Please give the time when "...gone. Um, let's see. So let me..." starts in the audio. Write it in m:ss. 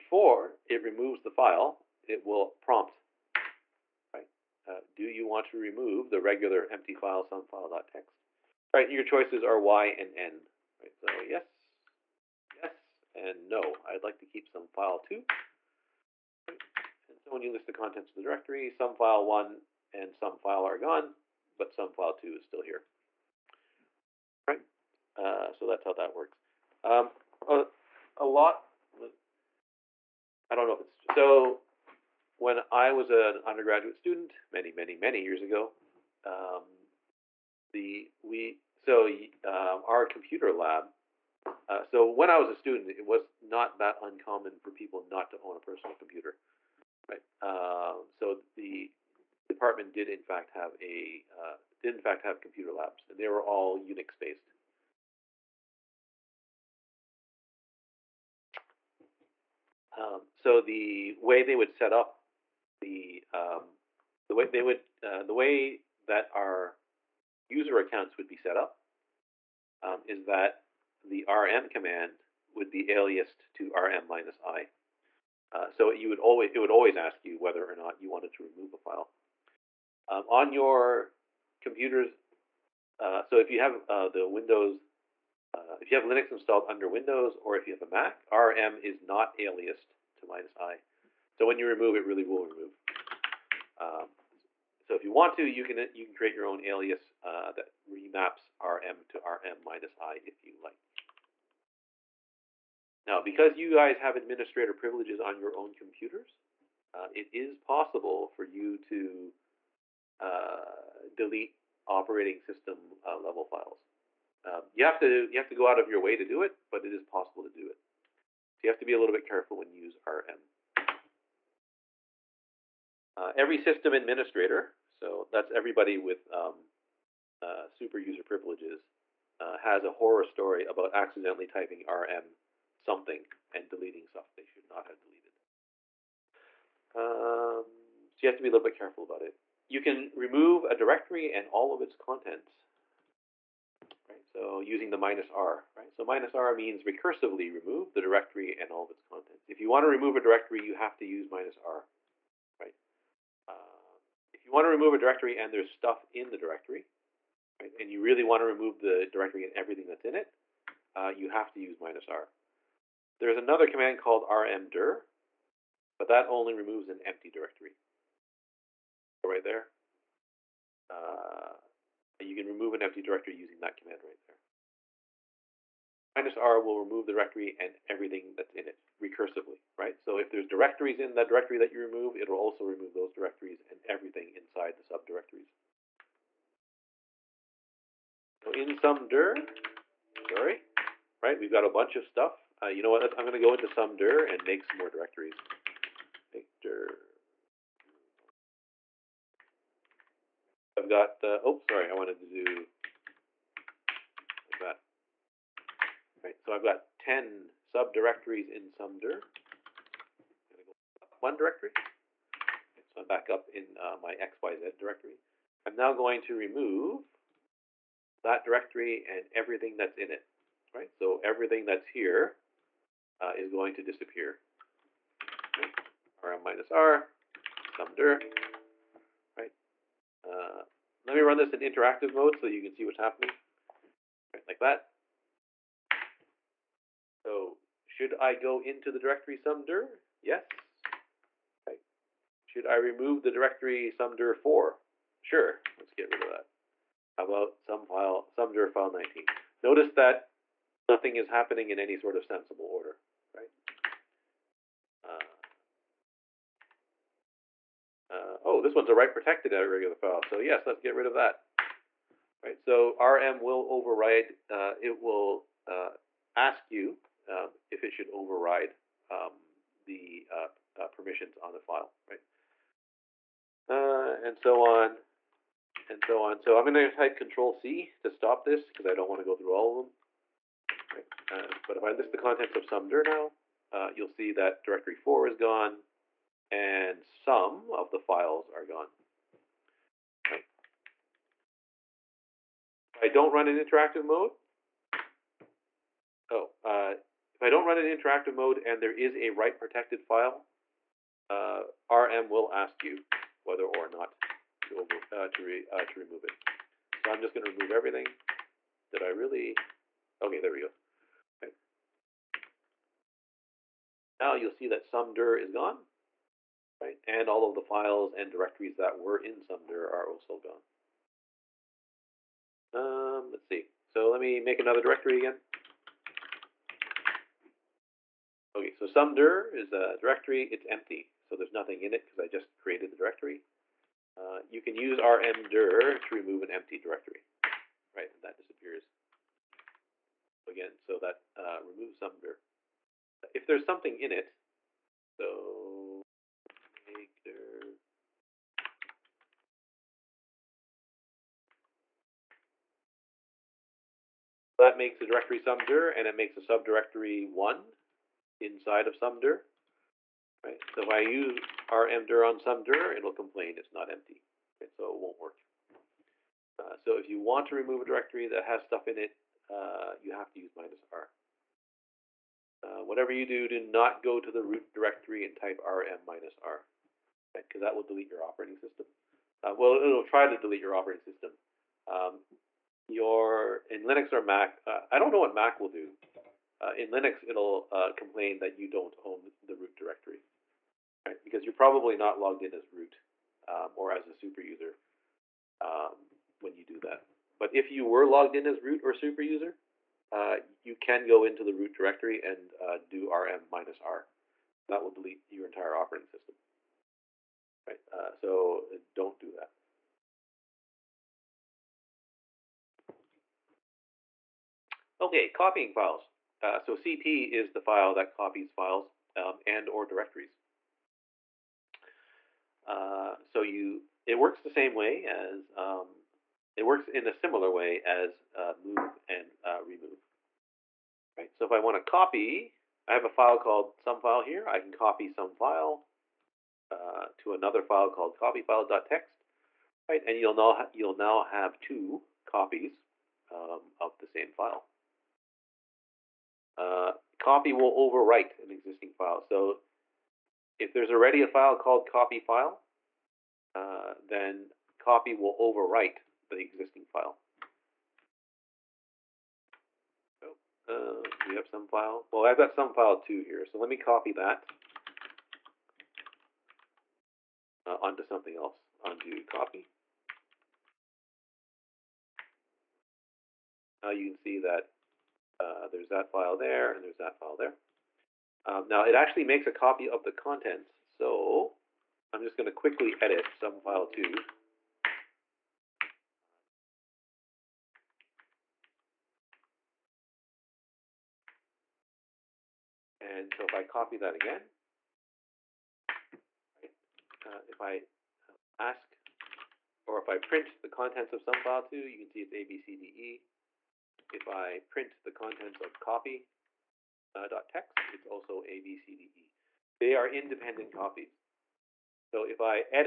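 5:22.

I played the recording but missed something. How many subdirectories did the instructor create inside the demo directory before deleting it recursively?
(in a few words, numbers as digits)
10.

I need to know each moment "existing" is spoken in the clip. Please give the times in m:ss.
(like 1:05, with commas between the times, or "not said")
7:28, 7:36.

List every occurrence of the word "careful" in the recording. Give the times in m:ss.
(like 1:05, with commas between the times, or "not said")
1:59, 2:18.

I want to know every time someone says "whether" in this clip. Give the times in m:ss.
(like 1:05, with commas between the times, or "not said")
1:17, 5:03.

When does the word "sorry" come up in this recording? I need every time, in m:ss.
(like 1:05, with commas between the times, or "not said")
3:10, 3:21.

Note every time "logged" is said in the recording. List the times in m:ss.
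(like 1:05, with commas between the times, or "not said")
6:32, 6:38.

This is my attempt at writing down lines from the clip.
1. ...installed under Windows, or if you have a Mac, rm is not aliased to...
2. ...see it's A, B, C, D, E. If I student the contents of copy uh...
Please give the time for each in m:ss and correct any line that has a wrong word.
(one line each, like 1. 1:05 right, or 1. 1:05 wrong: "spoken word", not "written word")
1. 1:26 right
2. 8:22 wrong: "print", not "student".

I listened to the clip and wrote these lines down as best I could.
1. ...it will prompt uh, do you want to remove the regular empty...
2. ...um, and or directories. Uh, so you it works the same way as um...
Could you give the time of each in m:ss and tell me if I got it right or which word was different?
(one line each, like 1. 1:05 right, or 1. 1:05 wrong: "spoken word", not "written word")
1. 0:02 right
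2. 6:59 right.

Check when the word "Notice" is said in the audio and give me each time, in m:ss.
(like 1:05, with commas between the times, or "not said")
4:09.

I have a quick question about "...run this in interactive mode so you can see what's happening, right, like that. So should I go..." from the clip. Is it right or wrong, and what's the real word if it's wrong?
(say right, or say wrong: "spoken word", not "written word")
right.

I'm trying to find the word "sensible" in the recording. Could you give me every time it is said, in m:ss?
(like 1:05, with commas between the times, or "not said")
4:12.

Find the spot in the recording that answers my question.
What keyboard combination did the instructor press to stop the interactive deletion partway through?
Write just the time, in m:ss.
4:37.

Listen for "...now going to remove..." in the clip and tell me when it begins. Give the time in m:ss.
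3:35.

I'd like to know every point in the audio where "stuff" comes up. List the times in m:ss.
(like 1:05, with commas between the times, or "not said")
2:14, 2:35, 3:12, 6:08.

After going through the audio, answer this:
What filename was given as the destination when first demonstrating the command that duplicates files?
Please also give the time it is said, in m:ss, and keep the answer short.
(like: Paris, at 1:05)
copyfile.txt, at 7:18.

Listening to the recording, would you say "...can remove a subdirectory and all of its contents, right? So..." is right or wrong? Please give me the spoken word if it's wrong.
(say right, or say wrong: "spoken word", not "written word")
wrong: "directory", not "subdirectory".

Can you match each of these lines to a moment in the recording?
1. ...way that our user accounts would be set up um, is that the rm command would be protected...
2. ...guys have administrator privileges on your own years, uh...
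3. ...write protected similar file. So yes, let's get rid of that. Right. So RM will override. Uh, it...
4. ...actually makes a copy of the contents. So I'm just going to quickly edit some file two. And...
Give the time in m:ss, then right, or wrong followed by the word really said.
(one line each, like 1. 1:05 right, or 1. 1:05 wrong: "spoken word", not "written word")
1. 1:05 wrong: "aliased", not "protected"
2. 1:43 wrong: "computers", not "years"
3. 4:18 wrong: "regular", not "similar"
4. 7:58 right.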